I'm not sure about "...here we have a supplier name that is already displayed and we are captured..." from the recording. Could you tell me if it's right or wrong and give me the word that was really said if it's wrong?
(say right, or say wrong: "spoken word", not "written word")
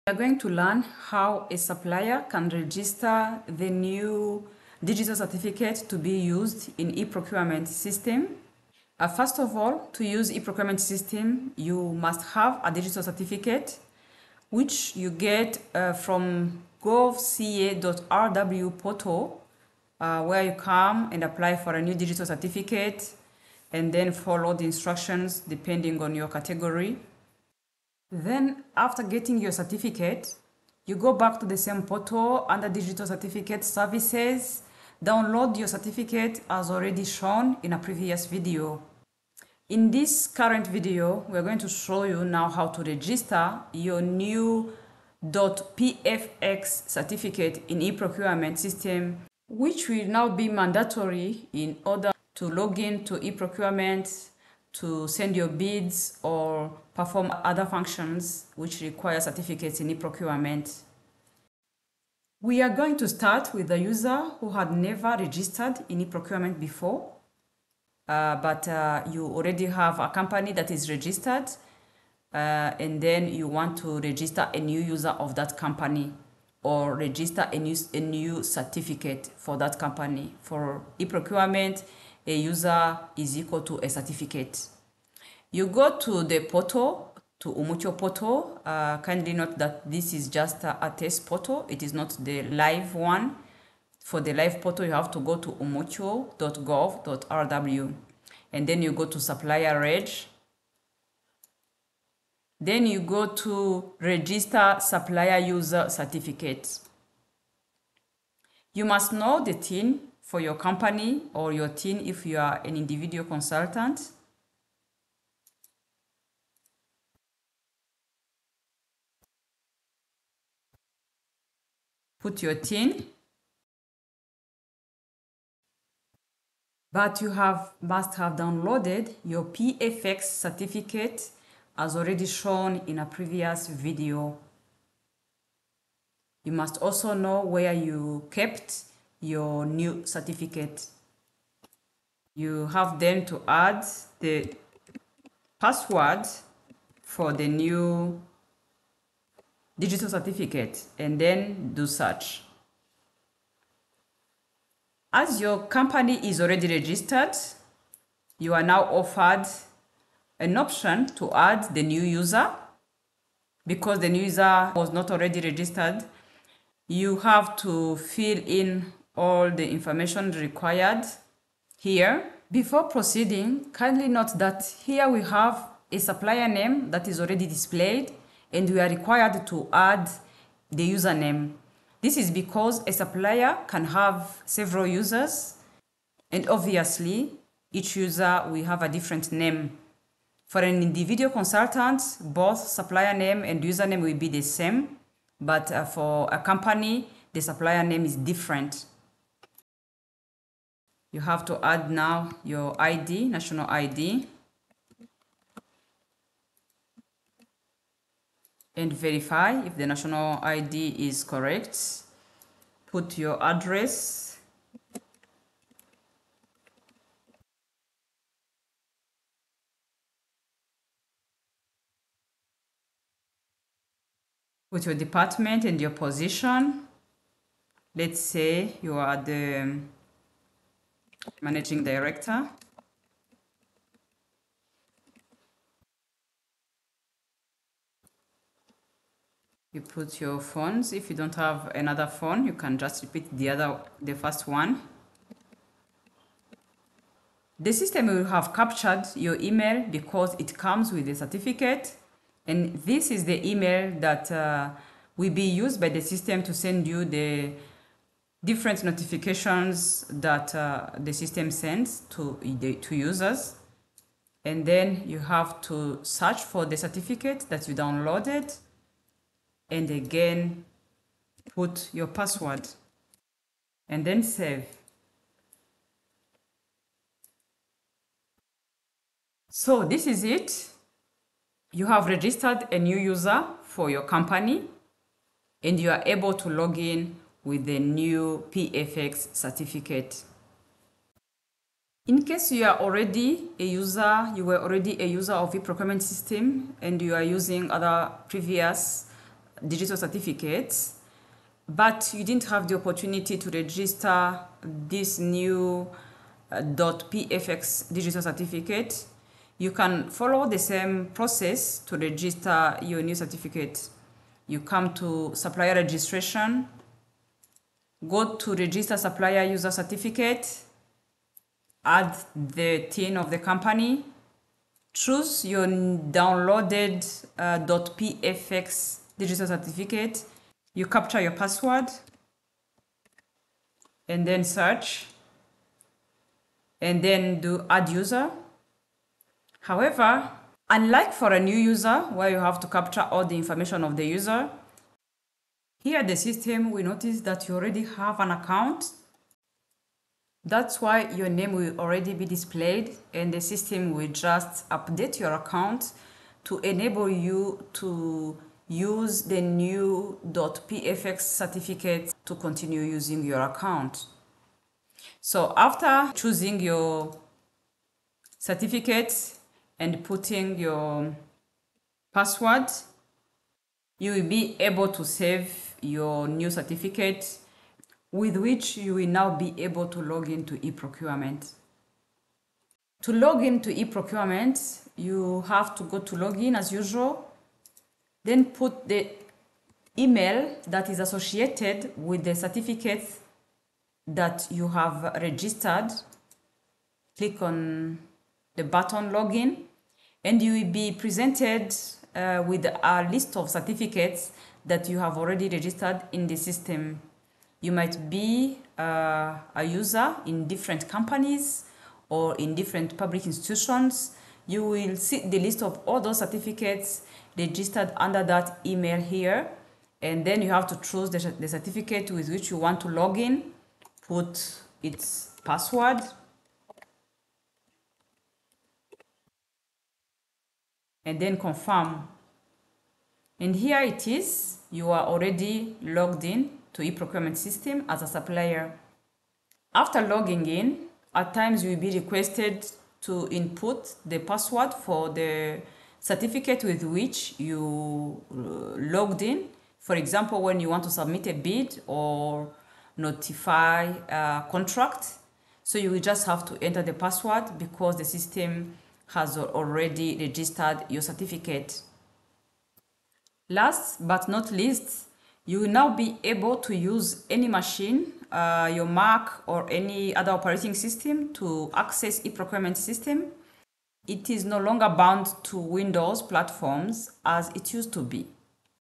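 wrong: "required", not "captured".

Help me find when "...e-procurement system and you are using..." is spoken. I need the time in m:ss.
4:55.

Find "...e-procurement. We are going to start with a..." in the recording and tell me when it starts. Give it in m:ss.
0:59.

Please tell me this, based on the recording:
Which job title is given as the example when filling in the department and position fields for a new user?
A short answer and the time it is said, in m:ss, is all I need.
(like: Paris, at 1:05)
Managing Director, at 3:51.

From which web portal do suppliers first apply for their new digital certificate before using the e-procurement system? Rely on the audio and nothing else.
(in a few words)
govca.rw.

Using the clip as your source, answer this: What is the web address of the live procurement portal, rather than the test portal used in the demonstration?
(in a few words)
umucyo.gov.rw.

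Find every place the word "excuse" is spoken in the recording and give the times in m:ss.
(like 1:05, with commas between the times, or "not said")
not said.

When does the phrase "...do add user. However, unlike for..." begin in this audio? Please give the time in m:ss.
5:37.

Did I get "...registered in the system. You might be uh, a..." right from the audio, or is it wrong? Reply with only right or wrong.
right.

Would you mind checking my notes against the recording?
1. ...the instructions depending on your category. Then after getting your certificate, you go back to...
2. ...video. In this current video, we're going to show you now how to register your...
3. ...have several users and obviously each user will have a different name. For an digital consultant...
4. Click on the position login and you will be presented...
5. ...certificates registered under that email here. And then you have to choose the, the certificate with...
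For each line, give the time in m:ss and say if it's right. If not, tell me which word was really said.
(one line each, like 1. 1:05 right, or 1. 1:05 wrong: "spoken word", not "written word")
1. 0:24 right
2. 0:38 right
3. 3:03 wrong: "individual", not "digital"
4. 6:37 wrong: "button", not "position"
5. 6:56 right.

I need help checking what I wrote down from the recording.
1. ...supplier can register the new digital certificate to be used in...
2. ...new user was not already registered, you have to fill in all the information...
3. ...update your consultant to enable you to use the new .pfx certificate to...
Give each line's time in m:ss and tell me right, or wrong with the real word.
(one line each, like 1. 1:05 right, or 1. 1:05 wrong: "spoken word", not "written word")
1. 0:01 right
2. 2:44 right
3. 5:54 wrong: "account", not "consultant".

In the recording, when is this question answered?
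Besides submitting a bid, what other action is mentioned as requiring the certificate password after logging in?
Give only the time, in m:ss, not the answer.
7:32.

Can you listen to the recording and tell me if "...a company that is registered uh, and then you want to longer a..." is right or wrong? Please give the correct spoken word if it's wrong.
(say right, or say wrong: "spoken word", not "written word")
wrong: "register", not "longer".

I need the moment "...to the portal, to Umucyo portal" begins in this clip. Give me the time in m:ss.
1:25.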